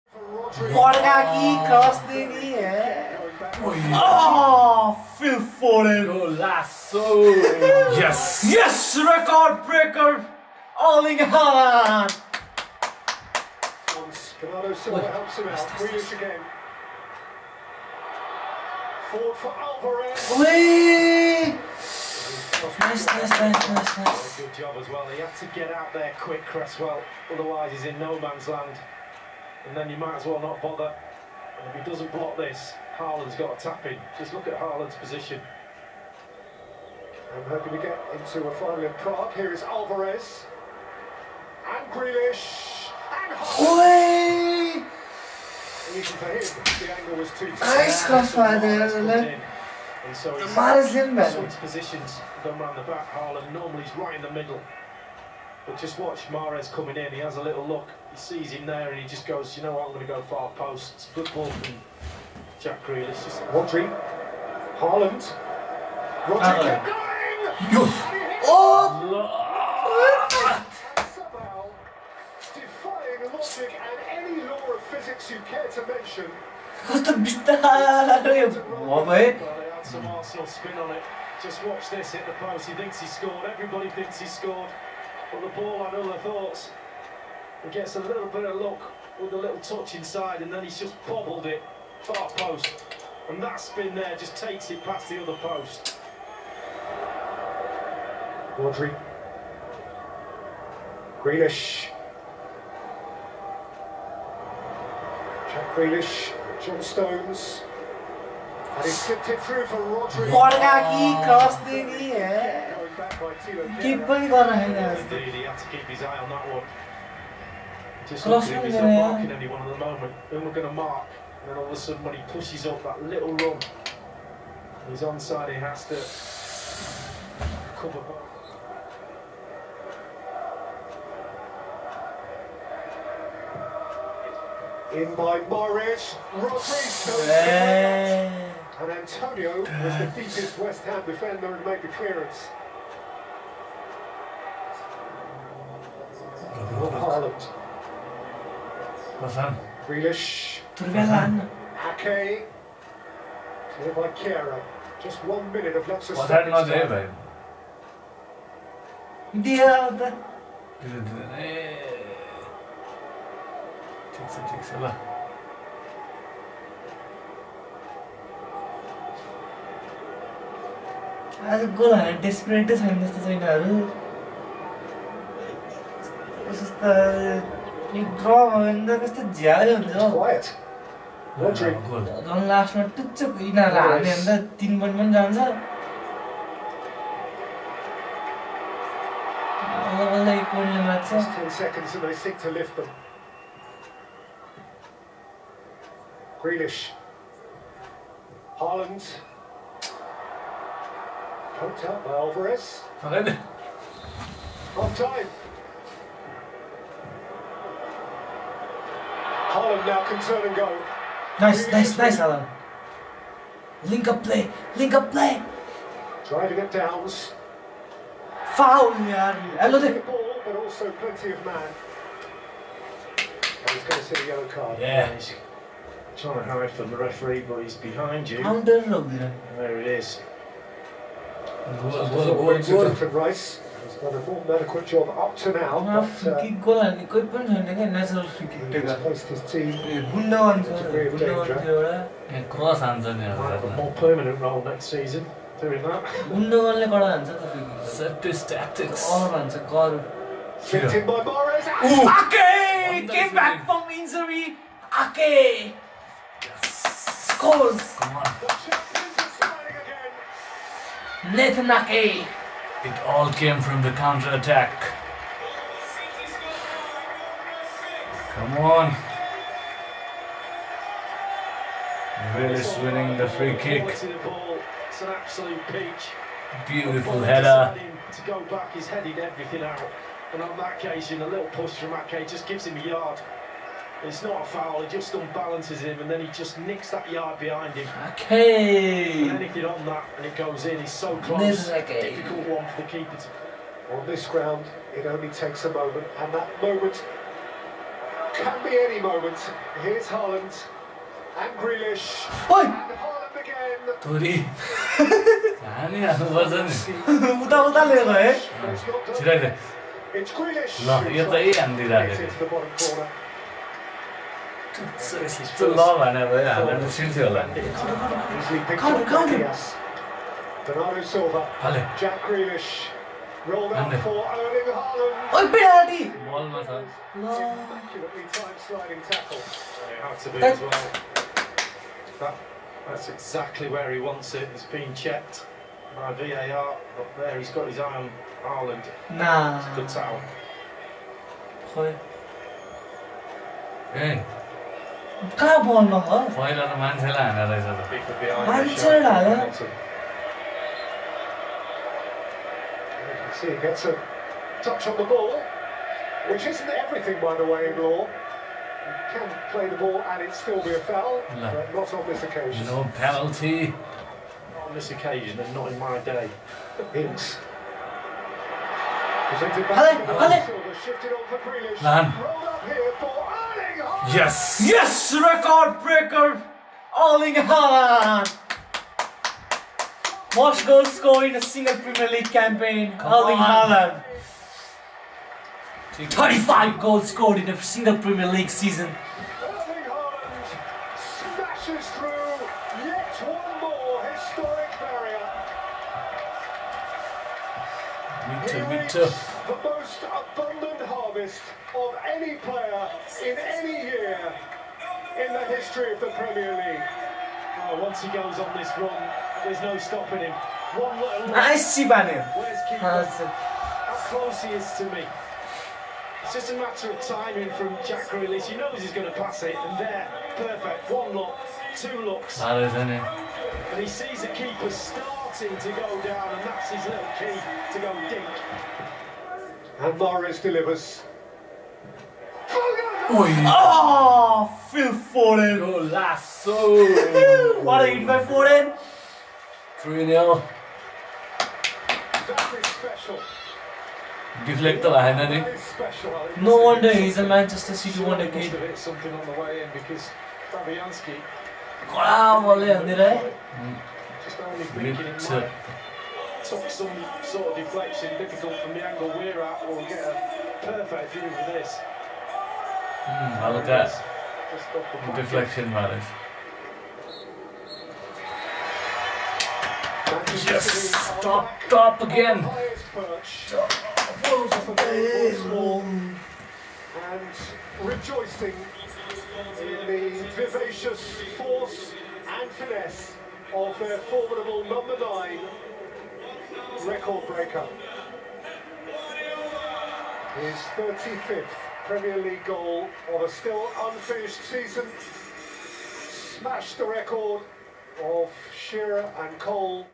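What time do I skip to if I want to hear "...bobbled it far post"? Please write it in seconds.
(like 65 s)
91 s.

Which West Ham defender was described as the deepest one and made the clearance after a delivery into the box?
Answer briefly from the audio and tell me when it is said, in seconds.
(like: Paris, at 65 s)
Antonio, at 138 s.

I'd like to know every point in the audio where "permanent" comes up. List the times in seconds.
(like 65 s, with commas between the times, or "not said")
243 s.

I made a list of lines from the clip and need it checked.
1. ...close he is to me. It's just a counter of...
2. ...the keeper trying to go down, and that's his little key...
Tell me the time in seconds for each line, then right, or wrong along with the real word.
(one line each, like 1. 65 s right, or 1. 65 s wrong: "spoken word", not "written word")
1. 414 s wrong: "matter", not "counter"
2. 424 s wrong: "starting", not "trying".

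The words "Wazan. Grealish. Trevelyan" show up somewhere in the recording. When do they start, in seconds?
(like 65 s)
149 s.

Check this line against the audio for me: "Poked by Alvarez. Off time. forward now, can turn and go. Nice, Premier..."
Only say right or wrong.
wrong.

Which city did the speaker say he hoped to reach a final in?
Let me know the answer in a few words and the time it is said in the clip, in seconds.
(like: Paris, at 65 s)
Prague, at 38 s.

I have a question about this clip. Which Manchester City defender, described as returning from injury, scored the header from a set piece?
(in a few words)
Nathan Ake.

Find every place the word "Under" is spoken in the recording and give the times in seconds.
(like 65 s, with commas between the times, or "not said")
228 s.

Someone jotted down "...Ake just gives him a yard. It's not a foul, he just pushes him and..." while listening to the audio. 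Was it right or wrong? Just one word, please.
wrong.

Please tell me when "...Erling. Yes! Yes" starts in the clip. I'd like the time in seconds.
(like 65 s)
373 s.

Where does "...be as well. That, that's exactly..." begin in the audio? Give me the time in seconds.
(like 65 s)
330 s.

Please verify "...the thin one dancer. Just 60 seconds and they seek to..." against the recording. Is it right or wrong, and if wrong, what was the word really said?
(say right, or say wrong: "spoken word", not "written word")
wrong: "10", not "60".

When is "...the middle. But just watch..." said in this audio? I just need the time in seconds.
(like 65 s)
54 s.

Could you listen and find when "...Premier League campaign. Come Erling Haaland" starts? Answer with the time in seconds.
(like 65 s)
381 s.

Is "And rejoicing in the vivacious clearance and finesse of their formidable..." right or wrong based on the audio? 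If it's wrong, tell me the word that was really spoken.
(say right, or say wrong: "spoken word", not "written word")
wrong: "force", not "clearance".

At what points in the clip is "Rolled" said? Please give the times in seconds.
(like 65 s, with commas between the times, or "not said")
323 s, 371 s.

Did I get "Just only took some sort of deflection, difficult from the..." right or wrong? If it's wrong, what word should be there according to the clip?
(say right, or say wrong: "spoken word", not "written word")
right.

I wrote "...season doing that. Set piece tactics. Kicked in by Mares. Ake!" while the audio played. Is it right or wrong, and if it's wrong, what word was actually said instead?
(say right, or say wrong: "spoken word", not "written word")
right.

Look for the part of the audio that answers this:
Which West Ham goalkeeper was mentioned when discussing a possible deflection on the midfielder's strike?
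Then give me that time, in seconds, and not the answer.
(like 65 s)
450 s.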